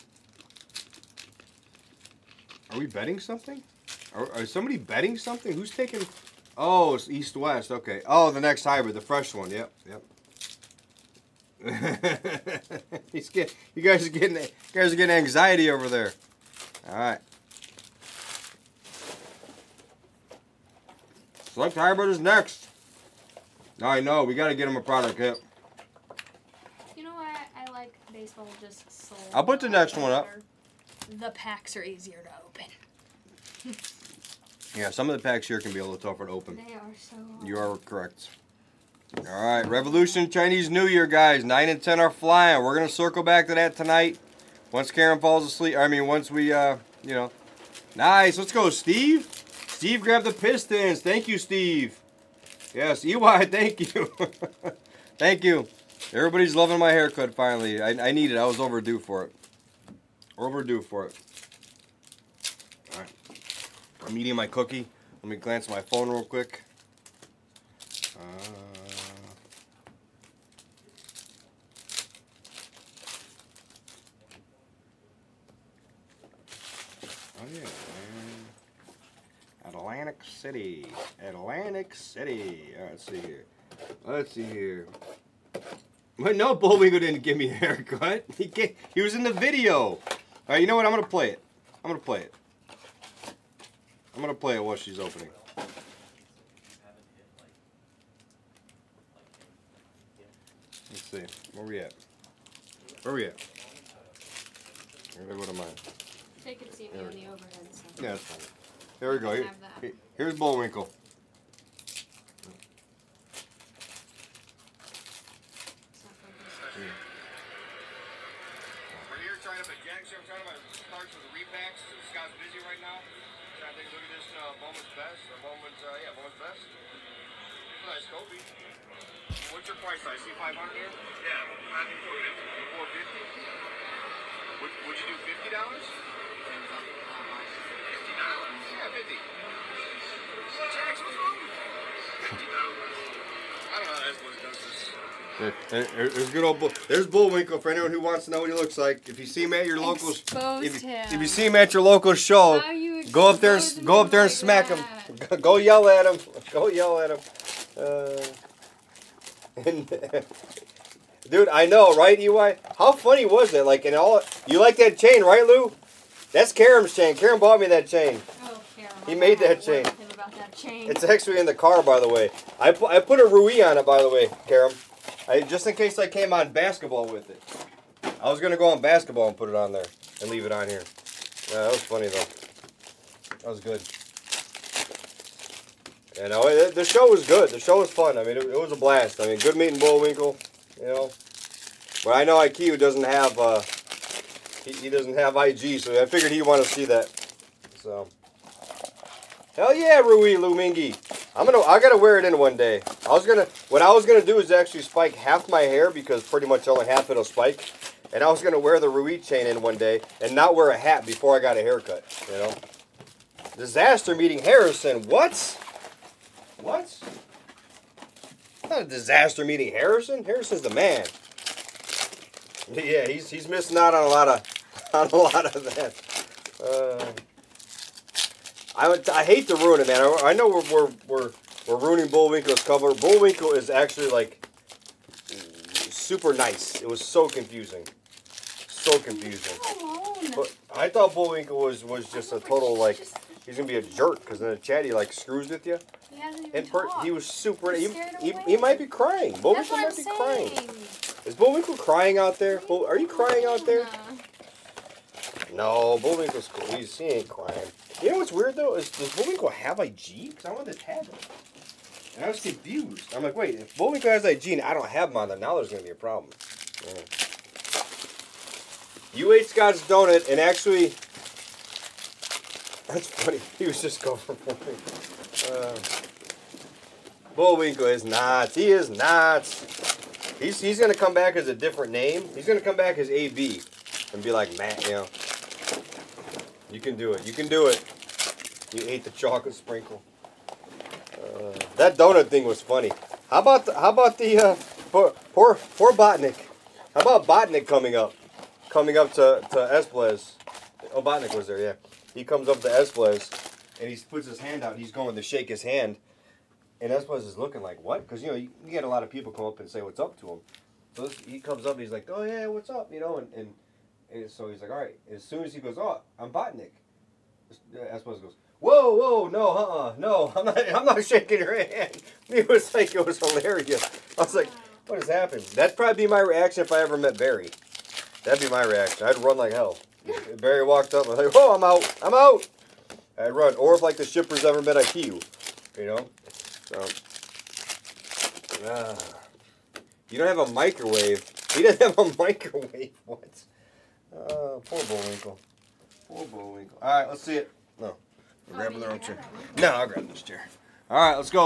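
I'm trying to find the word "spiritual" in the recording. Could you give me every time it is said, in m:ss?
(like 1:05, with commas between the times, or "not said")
not said.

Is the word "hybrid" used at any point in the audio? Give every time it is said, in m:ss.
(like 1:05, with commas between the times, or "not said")
0:08, 0:21.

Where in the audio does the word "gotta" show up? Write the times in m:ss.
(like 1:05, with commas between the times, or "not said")
3:21.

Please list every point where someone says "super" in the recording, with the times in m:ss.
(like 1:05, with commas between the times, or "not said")
3:55, 4:07.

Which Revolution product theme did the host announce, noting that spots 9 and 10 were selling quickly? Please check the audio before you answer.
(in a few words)
Chinese New Year.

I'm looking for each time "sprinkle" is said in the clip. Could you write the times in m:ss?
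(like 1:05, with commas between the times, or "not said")
4:49.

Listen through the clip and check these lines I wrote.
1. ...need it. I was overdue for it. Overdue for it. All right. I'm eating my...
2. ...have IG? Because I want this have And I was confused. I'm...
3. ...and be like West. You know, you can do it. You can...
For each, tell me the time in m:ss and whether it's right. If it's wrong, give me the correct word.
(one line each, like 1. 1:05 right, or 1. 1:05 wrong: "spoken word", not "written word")
1. 0:58 right
2. 4:19 right
3. 4:44 wrong: "Matt", not "West".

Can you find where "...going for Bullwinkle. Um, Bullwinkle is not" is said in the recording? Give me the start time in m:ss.
4:34.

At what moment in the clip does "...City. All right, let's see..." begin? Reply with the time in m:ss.
1:21.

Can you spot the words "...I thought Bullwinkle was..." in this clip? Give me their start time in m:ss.
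4:00.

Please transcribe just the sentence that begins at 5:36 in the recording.
So, uh, you don't have a microwave.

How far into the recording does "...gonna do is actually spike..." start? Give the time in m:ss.
3:24.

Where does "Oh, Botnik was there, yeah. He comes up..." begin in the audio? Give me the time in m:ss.
5:00.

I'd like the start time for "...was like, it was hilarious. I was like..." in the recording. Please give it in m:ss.
5:22.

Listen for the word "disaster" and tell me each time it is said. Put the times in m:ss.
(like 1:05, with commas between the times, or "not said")
3:33, 3:38.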